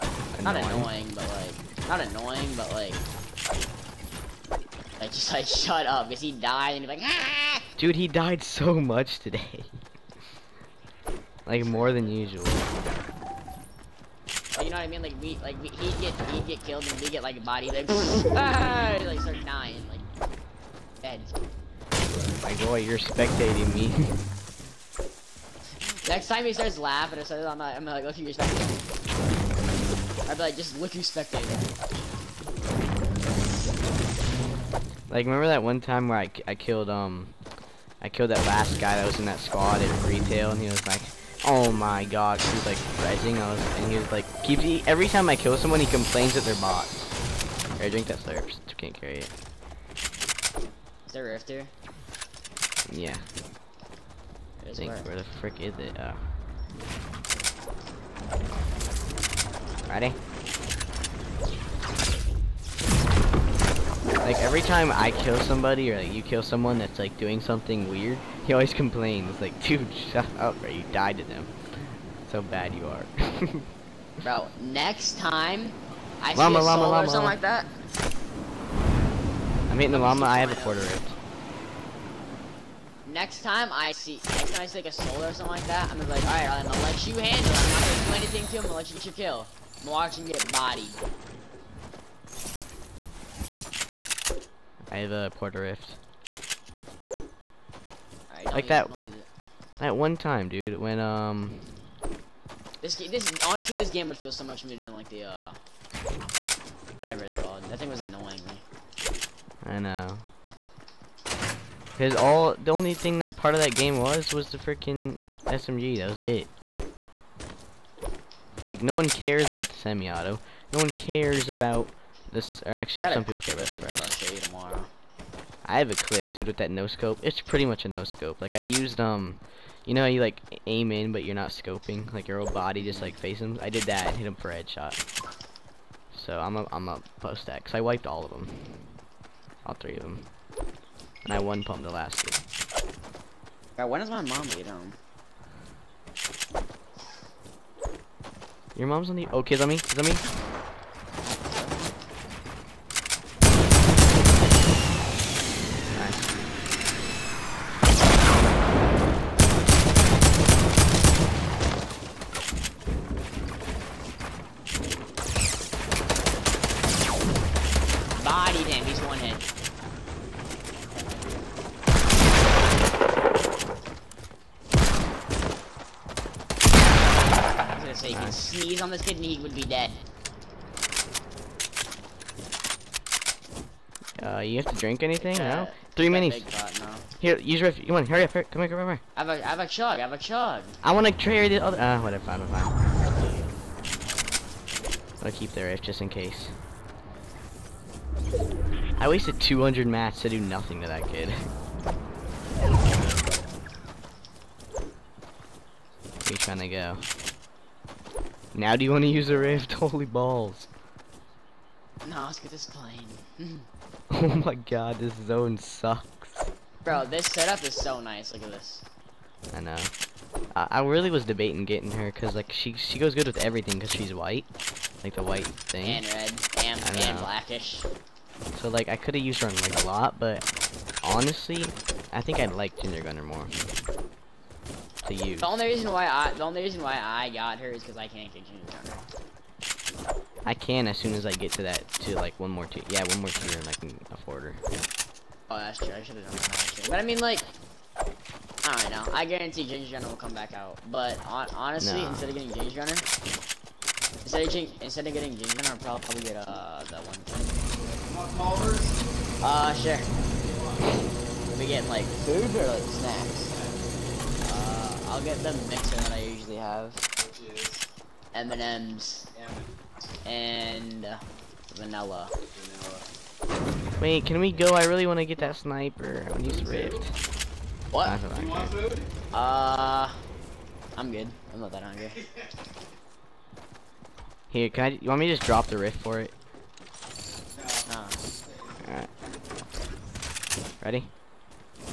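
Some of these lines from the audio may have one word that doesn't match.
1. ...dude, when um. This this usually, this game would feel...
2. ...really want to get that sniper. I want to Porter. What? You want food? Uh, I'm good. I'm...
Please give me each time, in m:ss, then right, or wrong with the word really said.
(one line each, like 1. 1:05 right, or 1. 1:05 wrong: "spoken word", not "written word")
1. 1:40 wrong: "honestly", not "usually"
2. 4:34 wrong: "Rift", not "Porter".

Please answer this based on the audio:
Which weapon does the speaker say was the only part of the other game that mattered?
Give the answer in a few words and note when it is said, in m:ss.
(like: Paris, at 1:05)
SMG, at 1:55.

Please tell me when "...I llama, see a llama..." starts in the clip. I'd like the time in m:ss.
1:16.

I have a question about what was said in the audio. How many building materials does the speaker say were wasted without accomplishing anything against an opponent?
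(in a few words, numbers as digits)
200.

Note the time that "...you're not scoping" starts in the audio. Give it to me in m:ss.
2:11.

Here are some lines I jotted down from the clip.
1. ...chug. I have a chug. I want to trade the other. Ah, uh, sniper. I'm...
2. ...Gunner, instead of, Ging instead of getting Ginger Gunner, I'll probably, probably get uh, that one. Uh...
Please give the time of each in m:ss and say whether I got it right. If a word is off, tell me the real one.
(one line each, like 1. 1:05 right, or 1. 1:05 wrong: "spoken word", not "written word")
1. 3:09 wrong: "whatever", not "sniper"
2. 4:12 right.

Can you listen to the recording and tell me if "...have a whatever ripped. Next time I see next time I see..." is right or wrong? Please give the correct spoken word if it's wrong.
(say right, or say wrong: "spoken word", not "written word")
wrong: "quarter", not "whatever".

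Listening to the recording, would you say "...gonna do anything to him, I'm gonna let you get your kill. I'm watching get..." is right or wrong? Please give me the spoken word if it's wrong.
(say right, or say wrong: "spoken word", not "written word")
right.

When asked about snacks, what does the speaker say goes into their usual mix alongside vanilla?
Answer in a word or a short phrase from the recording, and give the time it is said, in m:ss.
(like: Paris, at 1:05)
M&M's, at 4:28.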